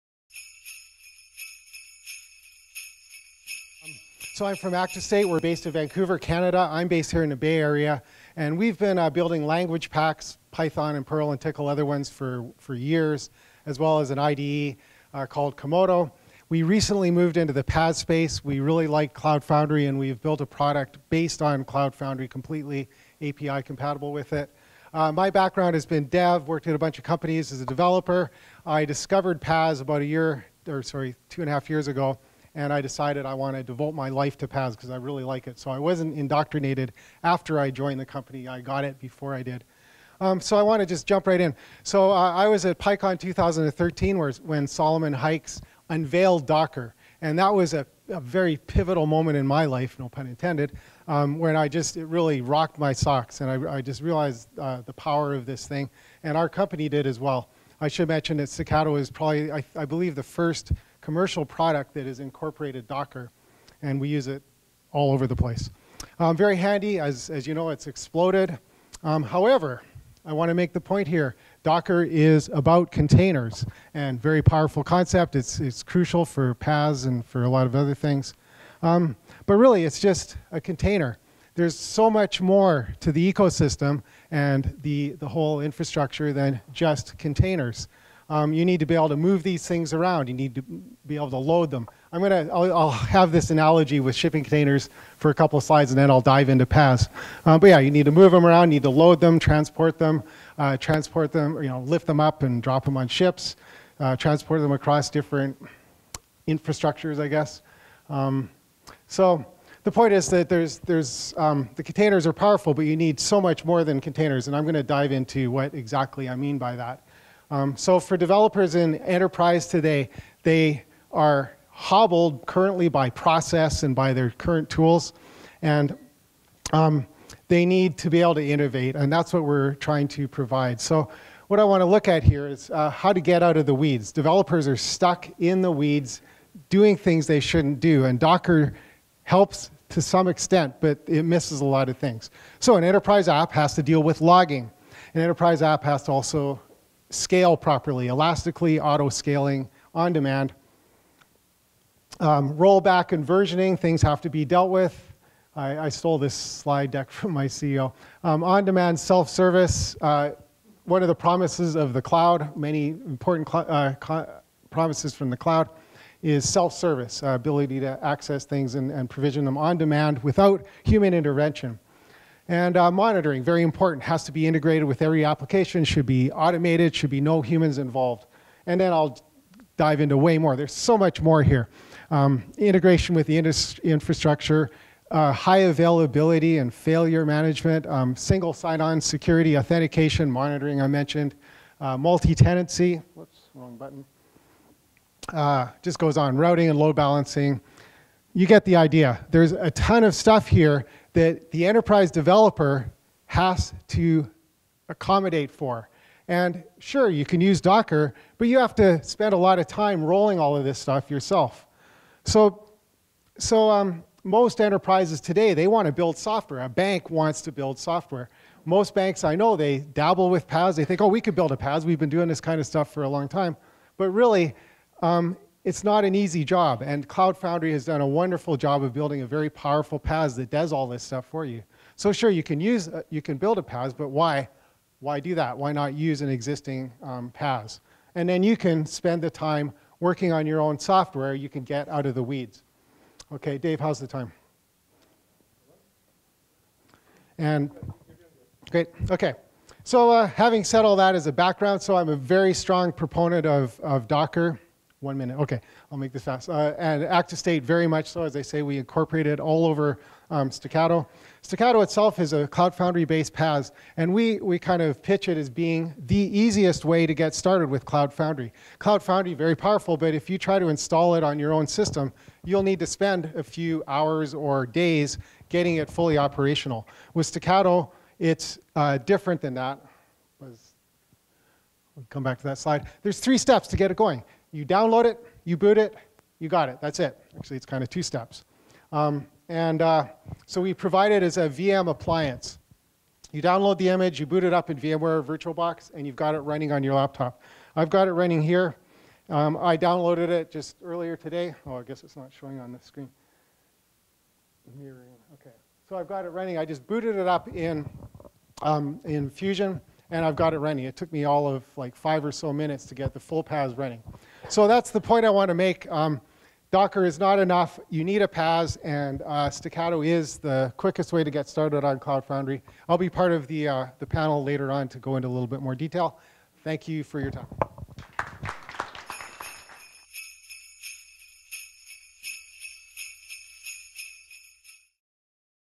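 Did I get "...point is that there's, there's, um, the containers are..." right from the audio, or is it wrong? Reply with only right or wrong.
right.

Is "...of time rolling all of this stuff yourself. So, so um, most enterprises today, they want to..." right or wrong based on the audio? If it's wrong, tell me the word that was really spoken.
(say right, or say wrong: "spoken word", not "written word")
right.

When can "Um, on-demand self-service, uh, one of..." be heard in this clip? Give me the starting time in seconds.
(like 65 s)
158 s.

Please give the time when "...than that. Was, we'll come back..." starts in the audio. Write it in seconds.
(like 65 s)
279 s.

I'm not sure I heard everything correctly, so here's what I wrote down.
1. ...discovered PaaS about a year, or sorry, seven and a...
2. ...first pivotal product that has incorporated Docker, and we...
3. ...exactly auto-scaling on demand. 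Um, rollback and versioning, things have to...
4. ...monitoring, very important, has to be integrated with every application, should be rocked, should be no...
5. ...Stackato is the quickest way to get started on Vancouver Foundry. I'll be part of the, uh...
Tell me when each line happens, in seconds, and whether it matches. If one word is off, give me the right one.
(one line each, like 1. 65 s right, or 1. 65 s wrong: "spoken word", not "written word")
1. 28 s wrong: "two", not "seven"
2. 60 s wrong: "commercial", not "pivotal"
3. 148 s wrong: "elastically", not "exactly"
4. 172 s wrong: "automated", not "rocked"
5. 319 s wrong: "Cloud", not "Vancouver".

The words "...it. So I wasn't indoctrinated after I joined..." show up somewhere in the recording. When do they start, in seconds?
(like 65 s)
35 s.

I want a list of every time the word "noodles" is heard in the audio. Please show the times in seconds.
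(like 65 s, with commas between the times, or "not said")
not said.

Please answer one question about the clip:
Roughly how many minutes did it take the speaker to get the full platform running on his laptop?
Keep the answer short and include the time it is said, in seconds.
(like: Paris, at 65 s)
5, at 311 s.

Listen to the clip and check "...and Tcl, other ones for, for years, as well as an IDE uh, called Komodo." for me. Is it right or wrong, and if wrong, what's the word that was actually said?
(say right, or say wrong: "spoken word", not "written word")
right.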